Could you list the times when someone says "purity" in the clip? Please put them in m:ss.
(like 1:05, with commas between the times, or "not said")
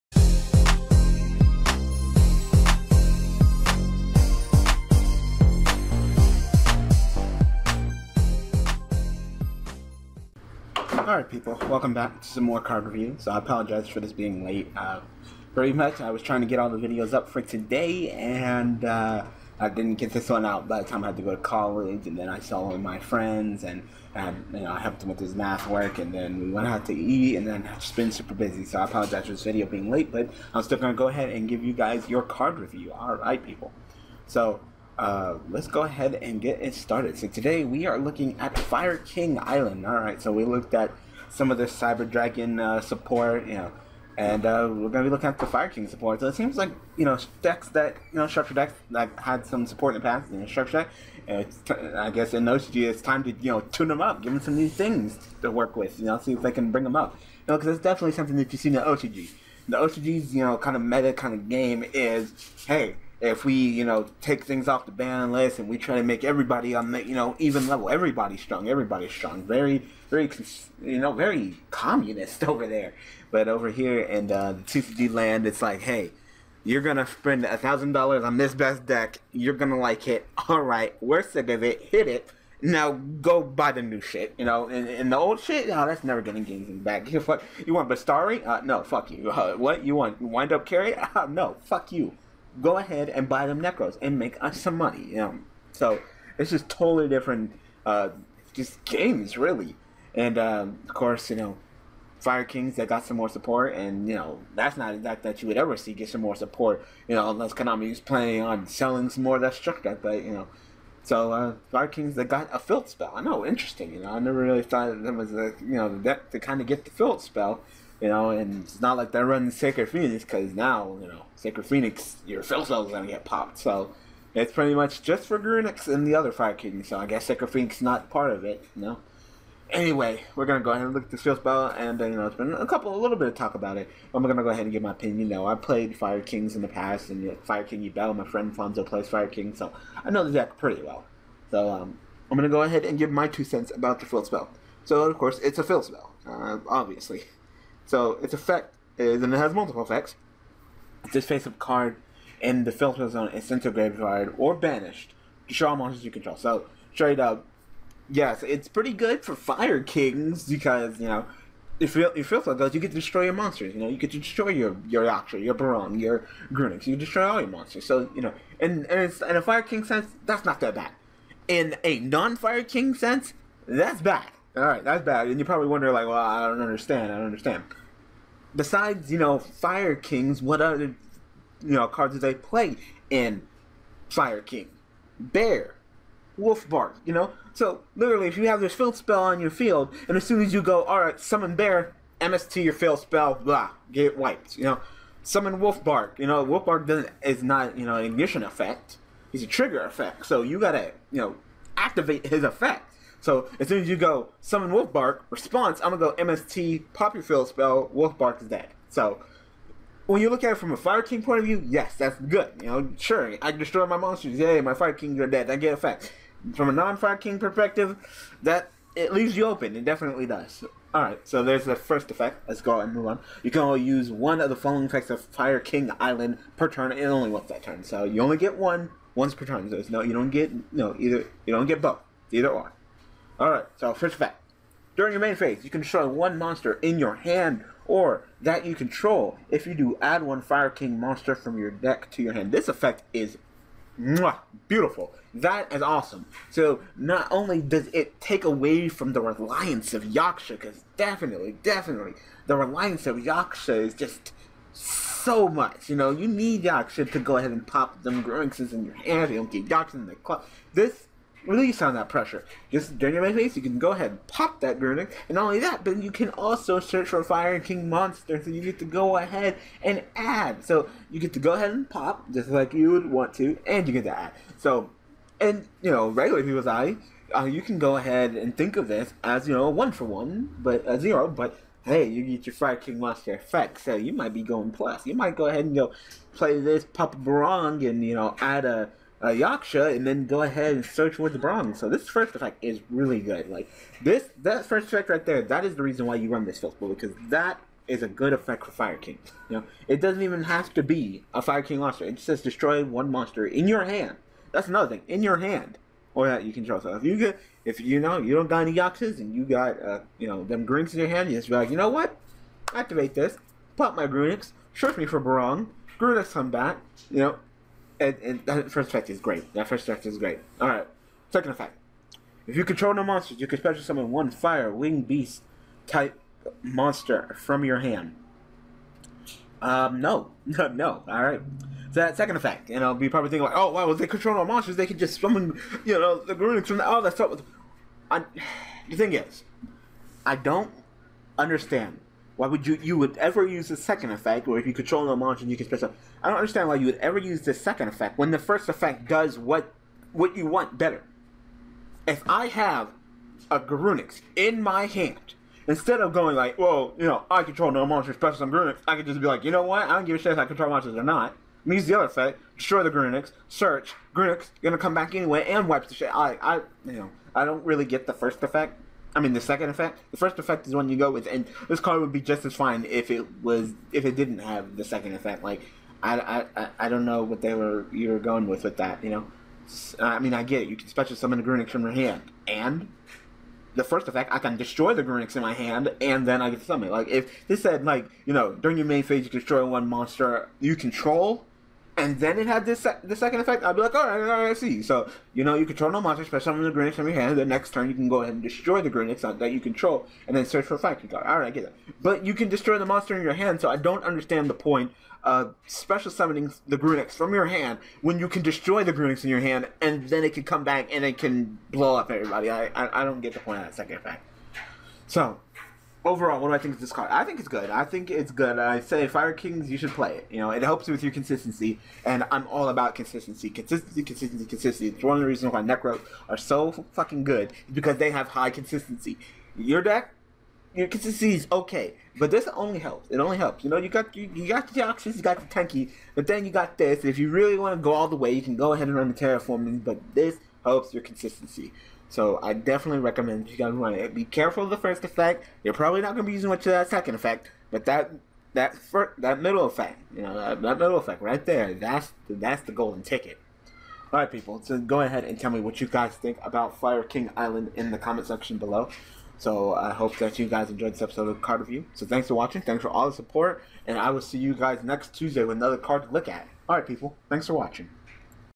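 not said.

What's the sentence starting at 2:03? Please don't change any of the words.
So it's pretty much just for Grunix and the other Fire Kingdom.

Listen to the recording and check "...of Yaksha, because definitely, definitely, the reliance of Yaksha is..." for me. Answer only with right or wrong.
right.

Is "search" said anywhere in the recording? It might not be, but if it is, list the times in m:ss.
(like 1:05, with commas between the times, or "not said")
4:26, 4:50, 5:14, 6:03, 6:40.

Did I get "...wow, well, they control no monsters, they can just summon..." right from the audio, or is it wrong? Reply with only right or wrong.
right.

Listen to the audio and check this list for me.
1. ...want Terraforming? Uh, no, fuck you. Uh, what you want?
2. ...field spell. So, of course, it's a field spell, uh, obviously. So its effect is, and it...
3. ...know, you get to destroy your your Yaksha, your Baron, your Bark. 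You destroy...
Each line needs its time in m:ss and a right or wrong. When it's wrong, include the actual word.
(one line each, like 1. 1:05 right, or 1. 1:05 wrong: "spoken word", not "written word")
1. 1:27 wrong: "Bastari", not "Terraforming"
2. 2:24 right
3. 2:43 wrong: "Grunix", not "Bark".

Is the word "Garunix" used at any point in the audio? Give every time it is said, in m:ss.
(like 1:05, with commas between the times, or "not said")
5:53, 5:58.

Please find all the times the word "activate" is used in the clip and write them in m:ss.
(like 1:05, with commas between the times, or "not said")
3:21, 5:12.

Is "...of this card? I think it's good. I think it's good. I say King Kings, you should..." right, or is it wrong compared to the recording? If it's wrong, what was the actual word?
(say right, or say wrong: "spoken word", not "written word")
wrong: "Fire", not "King".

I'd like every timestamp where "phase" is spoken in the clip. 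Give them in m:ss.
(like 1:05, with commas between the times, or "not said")
3:55, 6:29.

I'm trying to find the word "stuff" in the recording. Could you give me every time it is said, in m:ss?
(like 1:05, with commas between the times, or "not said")
5:37.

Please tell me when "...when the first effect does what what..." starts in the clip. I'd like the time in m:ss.
5:48.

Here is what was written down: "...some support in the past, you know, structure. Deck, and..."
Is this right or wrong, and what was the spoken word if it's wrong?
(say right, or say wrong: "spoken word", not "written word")
right.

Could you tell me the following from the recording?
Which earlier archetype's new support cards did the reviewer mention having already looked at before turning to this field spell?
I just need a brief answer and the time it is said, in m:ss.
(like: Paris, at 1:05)
Cyber Dragon, at 0:41.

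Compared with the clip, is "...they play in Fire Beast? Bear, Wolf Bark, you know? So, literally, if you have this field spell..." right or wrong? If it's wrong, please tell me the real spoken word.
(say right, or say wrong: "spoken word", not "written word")
wrong: "King", not "Beast".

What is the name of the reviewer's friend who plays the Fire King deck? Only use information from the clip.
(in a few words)
Fonzo.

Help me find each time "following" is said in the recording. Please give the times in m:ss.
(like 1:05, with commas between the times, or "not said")
3:44.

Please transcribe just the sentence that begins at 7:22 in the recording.
So I definitely recommend you guys run it.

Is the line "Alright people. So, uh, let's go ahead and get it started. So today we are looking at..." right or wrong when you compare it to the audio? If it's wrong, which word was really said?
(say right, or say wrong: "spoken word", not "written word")
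right.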